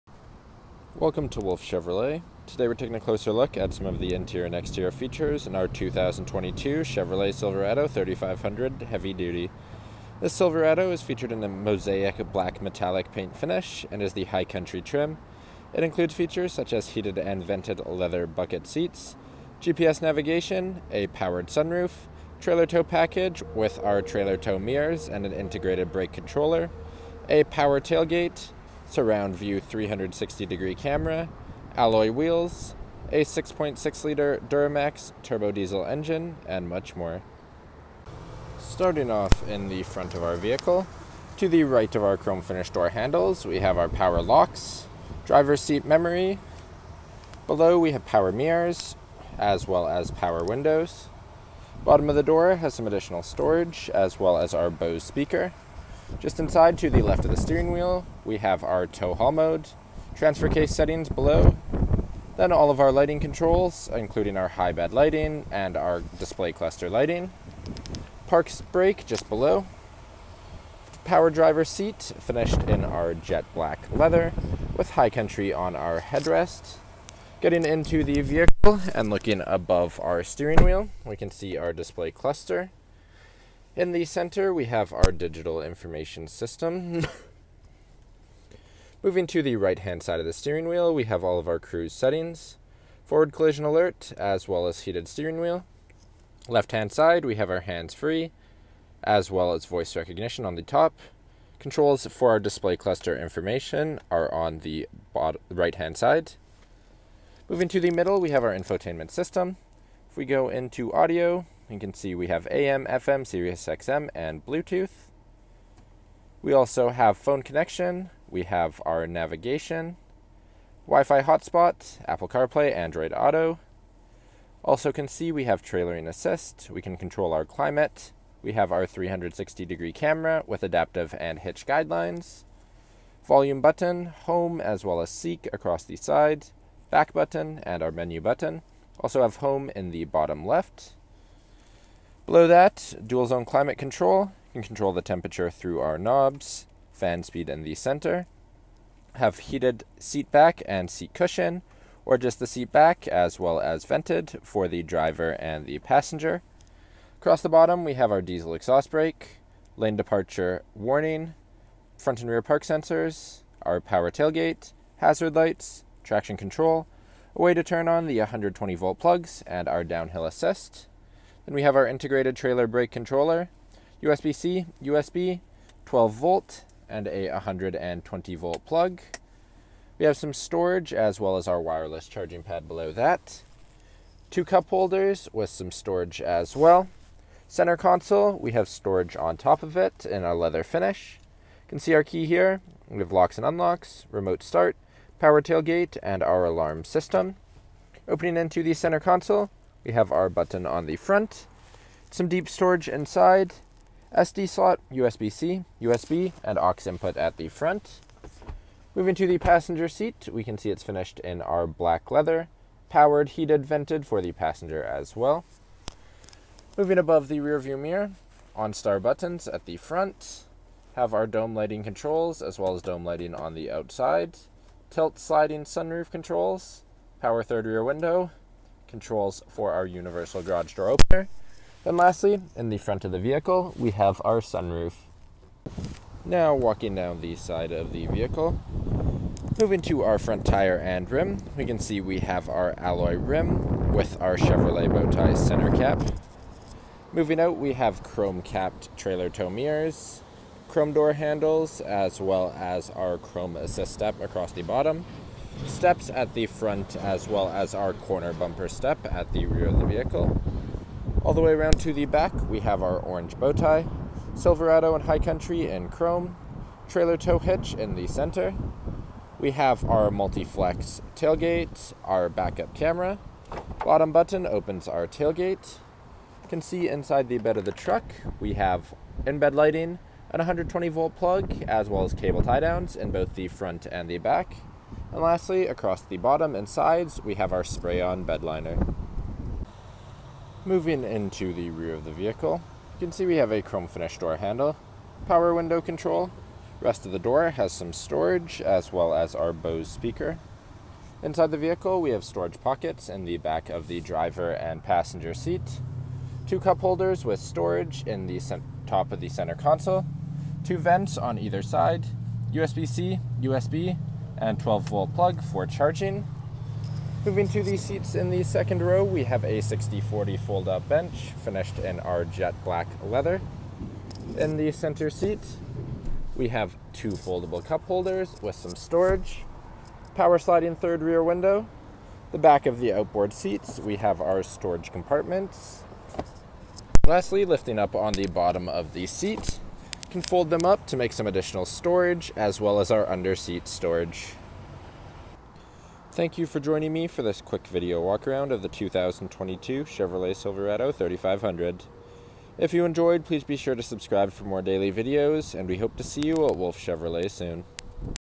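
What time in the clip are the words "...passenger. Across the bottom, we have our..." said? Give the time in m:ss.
2:35.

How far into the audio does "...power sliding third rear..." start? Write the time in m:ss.
5:30.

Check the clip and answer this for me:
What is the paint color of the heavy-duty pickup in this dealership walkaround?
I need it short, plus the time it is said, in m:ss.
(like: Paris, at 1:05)
Mosaic black metallic, at 0:11.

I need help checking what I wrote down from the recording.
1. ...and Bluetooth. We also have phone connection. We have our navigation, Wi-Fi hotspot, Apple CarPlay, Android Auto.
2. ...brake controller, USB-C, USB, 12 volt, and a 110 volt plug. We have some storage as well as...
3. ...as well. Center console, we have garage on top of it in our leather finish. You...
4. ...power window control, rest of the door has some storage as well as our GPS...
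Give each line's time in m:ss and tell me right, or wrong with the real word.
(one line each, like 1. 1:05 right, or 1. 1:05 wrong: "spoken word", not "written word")
1. 1:54 right
2. 2:52 wrong: "120", not "110"
3. 3:06 wrong: "storage", not "garage"
4. 4:55 wrong: "Bose", not "GPS".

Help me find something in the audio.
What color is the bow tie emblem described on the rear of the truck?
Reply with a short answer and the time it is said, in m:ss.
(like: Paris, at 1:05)
Orange, at 4:22.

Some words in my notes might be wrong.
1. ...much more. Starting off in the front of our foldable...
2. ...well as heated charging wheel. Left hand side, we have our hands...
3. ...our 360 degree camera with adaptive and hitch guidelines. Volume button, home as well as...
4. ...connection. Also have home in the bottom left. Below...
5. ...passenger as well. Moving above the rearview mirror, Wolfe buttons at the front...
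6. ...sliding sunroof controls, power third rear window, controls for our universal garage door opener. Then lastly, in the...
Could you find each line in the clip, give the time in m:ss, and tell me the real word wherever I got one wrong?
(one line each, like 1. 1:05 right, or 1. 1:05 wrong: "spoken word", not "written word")
1. 0:36 wrong: "vehicle", not "foldable"
2. 1:34 wrong: "steering", not "charging"
3. 2:08 right
4. 2:18 wrong: "button", not "connection"
5. 3:34 wrong: "OnStar", not "Wolfe"
6. 3:45 right.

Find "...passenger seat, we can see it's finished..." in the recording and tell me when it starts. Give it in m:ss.
3:29.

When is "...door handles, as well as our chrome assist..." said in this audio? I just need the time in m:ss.
4:10.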